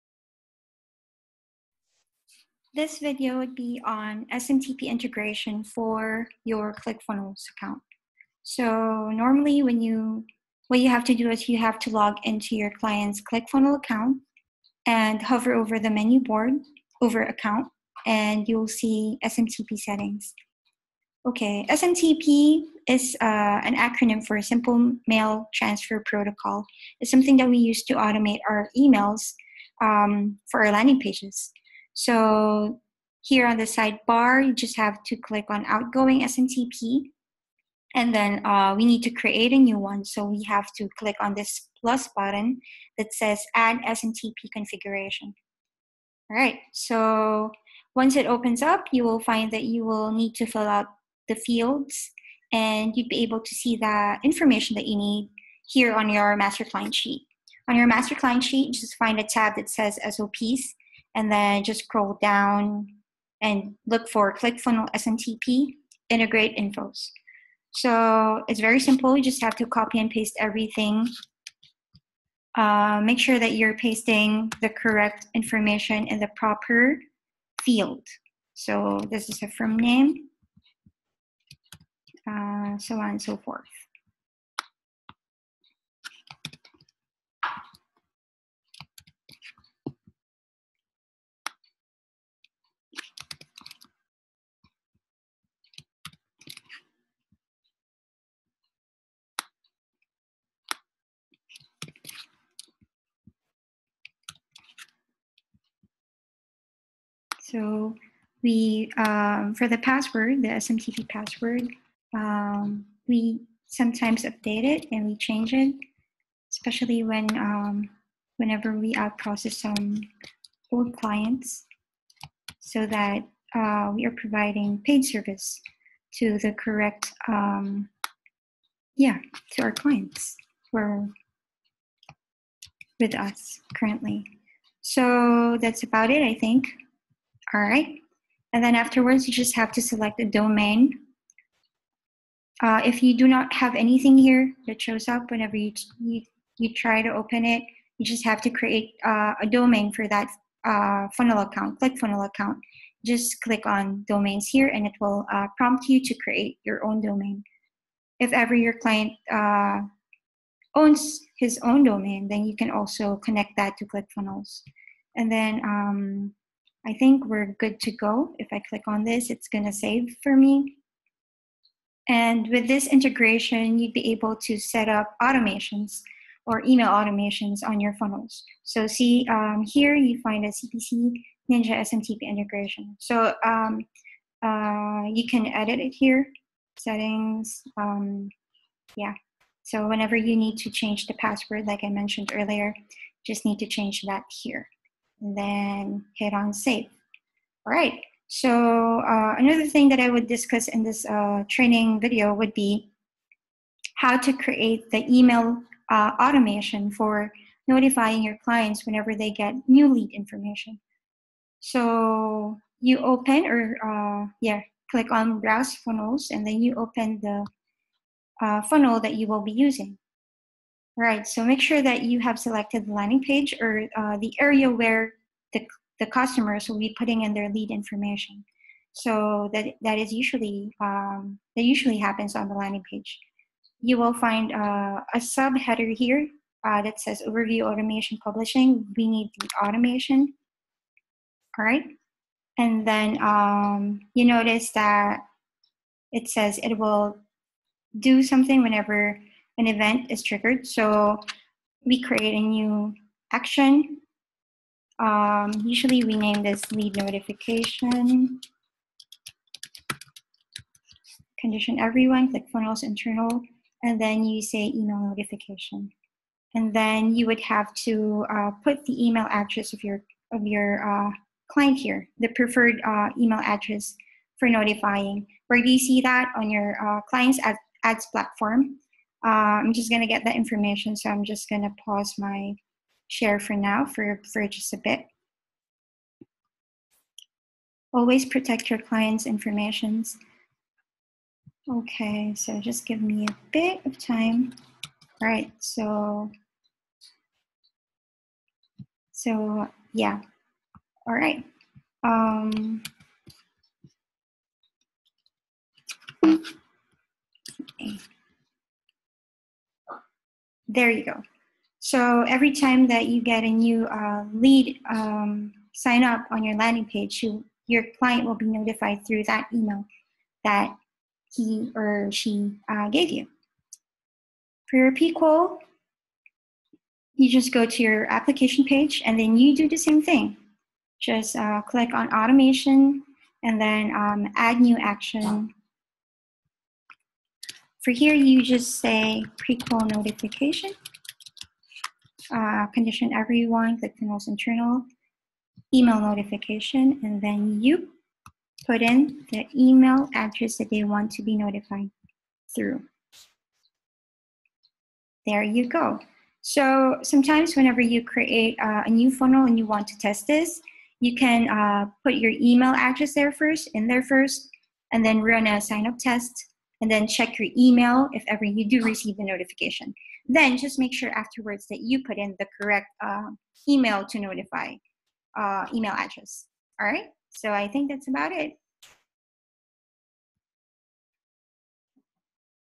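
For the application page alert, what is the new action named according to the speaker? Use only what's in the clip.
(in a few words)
prequal notification.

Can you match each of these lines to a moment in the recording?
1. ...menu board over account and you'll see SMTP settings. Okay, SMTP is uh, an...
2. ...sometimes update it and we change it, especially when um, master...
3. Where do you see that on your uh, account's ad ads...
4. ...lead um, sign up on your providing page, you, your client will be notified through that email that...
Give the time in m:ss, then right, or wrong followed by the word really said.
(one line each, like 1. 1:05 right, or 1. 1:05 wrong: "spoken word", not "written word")
1. 0:15 right
2. 1:53 wrong: "whenever", not "master"
3. 4:35 wrong: "client", not "account"
4. 5:14 wrong: "landing", not "providing".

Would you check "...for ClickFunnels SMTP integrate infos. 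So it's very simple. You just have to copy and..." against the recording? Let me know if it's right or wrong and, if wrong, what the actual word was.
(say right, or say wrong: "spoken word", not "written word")
right.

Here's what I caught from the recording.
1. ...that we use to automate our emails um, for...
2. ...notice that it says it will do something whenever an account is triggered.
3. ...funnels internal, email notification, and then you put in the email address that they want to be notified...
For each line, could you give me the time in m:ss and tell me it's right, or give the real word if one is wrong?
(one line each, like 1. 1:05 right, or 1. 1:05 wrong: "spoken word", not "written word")
1. 0:27 right
2. 4:04 wrong: "event", not "account"
3. 5:43 right.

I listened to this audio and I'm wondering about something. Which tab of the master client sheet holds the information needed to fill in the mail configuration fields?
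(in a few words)
SOPs.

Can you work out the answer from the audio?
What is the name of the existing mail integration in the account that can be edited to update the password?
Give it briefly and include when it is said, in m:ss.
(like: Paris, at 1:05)
CPC Ninja SMTP integration, at 3:00.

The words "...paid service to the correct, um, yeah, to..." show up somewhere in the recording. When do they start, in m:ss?
2:04.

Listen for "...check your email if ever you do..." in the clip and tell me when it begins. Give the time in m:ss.
6:07.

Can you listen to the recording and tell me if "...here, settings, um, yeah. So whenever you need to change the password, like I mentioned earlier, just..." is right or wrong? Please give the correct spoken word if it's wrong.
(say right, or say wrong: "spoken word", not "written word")
right.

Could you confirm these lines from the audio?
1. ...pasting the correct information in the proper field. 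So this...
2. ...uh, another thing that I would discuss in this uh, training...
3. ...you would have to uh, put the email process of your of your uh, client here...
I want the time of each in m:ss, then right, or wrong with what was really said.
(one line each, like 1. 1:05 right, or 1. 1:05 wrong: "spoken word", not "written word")
1. 1:13 right
2. 3:19 right
3. 4:27 wrong: "address", not "process".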